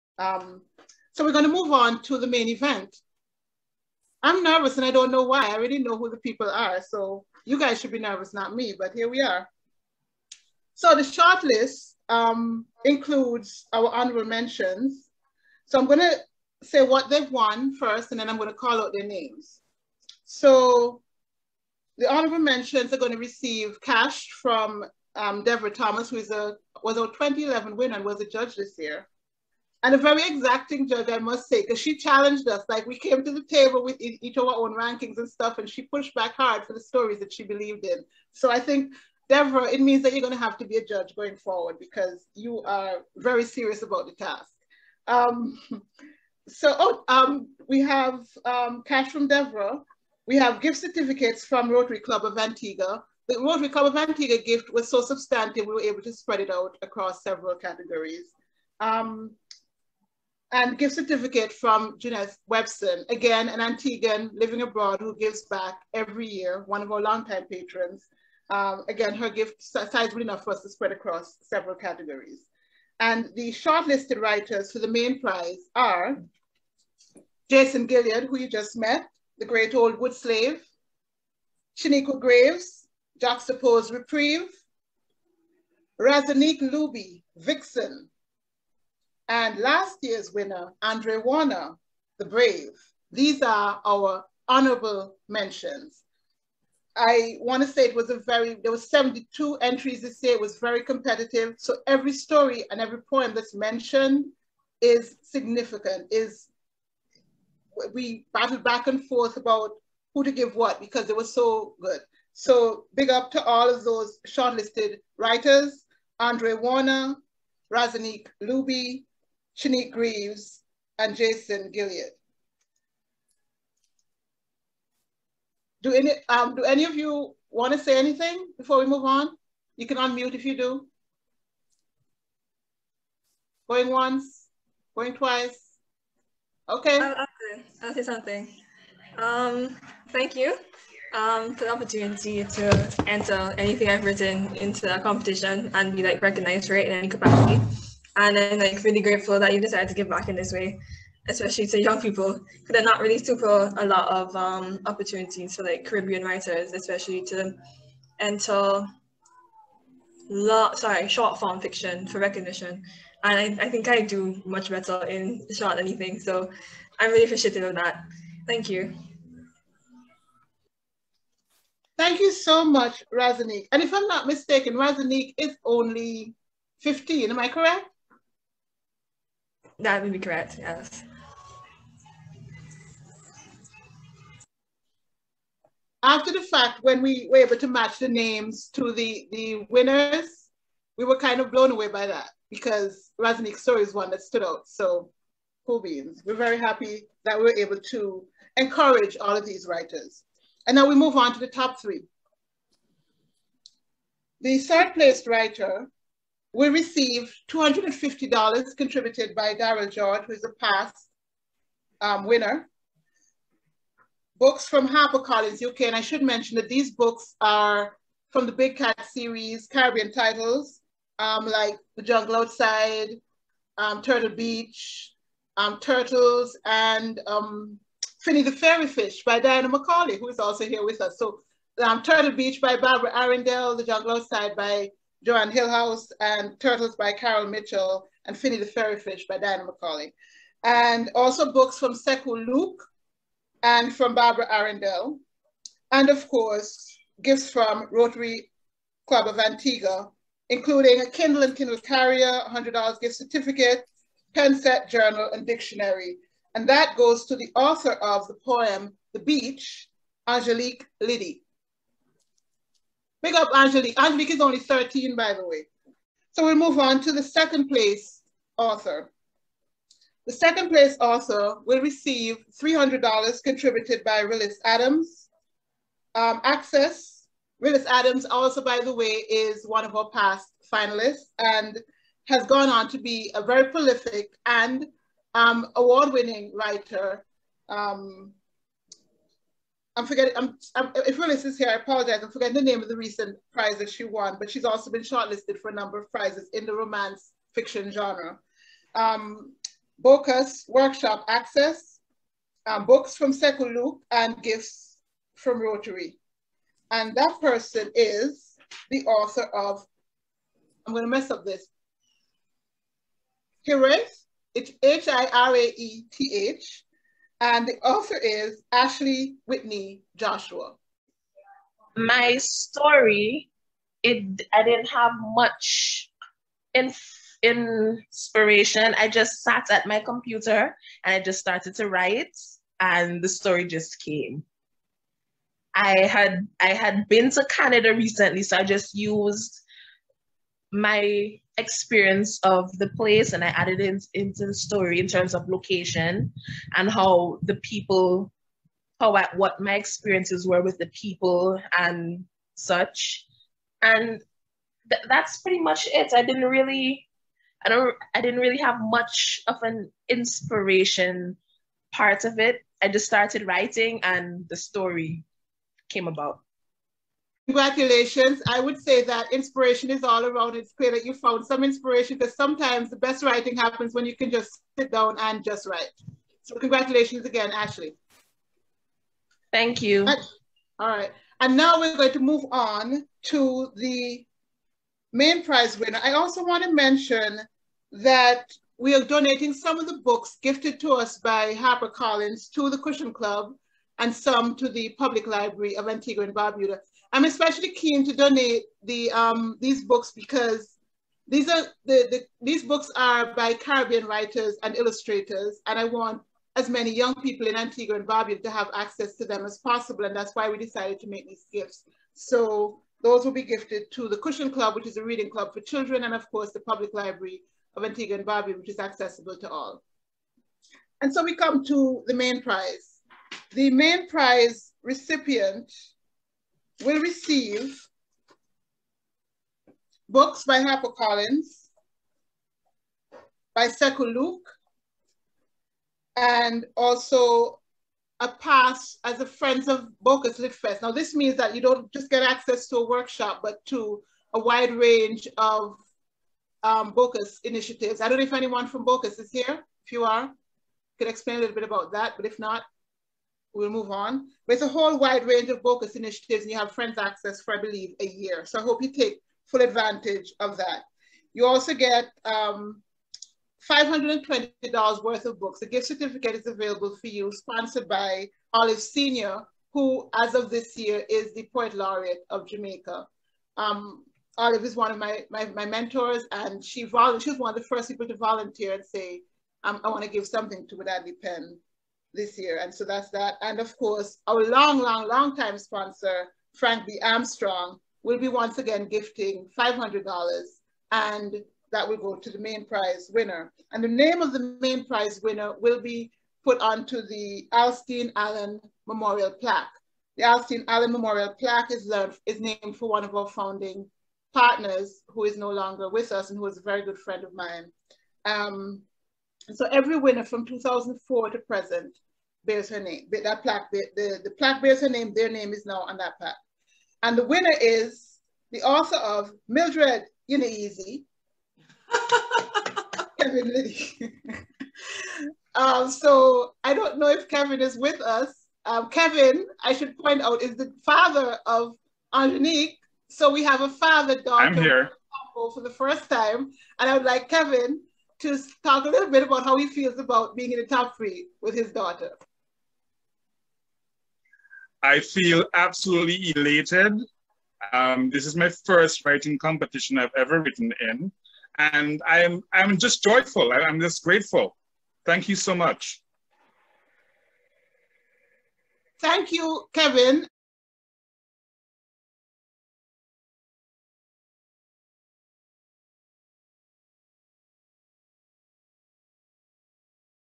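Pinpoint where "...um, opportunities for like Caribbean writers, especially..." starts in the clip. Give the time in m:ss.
2:34.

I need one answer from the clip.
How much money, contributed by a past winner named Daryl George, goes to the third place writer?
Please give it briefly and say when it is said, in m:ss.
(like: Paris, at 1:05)
$250, at 3:27.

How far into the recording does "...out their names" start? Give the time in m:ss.
0:18.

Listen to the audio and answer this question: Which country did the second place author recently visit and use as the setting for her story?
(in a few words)
Canada.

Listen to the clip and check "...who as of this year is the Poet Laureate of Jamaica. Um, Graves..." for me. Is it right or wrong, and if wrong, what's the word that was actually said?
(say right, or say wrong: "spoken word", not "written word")
wrong: "Olive", not "Graves".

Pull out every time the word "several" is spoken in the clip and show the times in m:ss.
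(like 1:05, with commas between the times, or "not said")
0:57, 1:11.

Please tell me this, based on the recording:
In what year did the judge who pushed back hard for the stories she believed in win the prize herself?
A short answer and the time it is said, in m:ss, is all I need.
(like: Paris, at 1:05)
2011, at 0:27.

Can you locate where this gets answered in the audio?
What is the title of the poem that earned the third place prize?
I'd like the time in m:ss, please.
4:19.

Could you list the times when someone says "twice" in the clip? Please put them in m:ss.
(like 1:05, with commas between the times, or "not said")
2:15.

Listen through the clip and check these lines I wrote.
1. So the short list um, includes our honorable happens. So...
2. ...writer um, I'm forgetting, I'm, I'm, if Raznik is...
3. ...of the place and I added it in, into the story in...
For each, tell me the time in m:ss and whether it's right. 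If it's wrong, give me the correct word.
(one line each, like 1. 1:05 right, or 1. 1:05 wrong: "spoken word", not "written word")
1. 0:10 wrong: "mentions", not "happens"
2. 4:46 wrong: "Willis", not "Raznik"
3. 5:42 right.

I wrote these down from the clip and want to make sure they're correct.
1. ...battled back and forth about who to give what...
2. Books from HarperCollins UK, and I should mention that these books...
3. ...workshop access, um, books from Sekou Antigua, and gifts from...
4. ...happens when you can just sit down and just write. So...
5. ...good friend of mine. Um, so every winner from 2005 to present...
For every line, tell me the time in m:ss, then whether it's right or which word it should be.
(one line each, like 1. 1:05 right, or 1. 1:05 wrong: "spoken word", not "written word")
1. 1:48 right
2. 3:34 right
3. 5:00 wrong: "Luke", not "Antigua"
4. 6:13 right
5. 8:26 wrong: "2004", not "2005".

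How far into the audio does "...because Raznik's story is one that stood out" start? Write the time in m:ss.
3:12.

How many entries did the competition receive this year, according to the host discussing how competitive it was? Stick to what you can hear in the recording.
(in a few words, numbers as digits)
72.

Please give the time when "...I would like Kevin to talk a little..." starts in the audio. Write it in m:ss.
8:56.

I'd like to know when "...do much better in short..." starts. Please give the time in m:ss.
2:44.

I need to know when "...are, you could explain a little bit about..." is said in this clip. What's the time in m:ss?
7:30.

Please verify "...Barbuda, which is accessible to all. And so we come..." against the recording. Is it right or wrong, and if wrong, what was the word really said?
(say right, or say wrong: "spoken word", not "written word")
right.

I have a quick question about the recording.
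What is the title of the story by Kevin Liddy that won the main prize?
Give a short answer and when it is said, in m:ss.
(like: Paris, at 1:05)
Mildred easy, at 8:39.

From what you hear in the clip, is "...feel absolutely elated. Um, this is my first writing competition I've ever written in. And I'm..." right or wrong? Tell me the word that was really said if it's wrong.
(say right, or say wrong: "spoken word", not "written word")
right.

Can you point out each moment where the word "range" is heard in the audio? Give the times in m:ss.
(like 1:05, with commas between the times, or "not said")
7:24, 7:35.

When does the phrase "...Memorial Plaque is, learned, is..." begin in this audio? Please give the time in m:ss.
8:20.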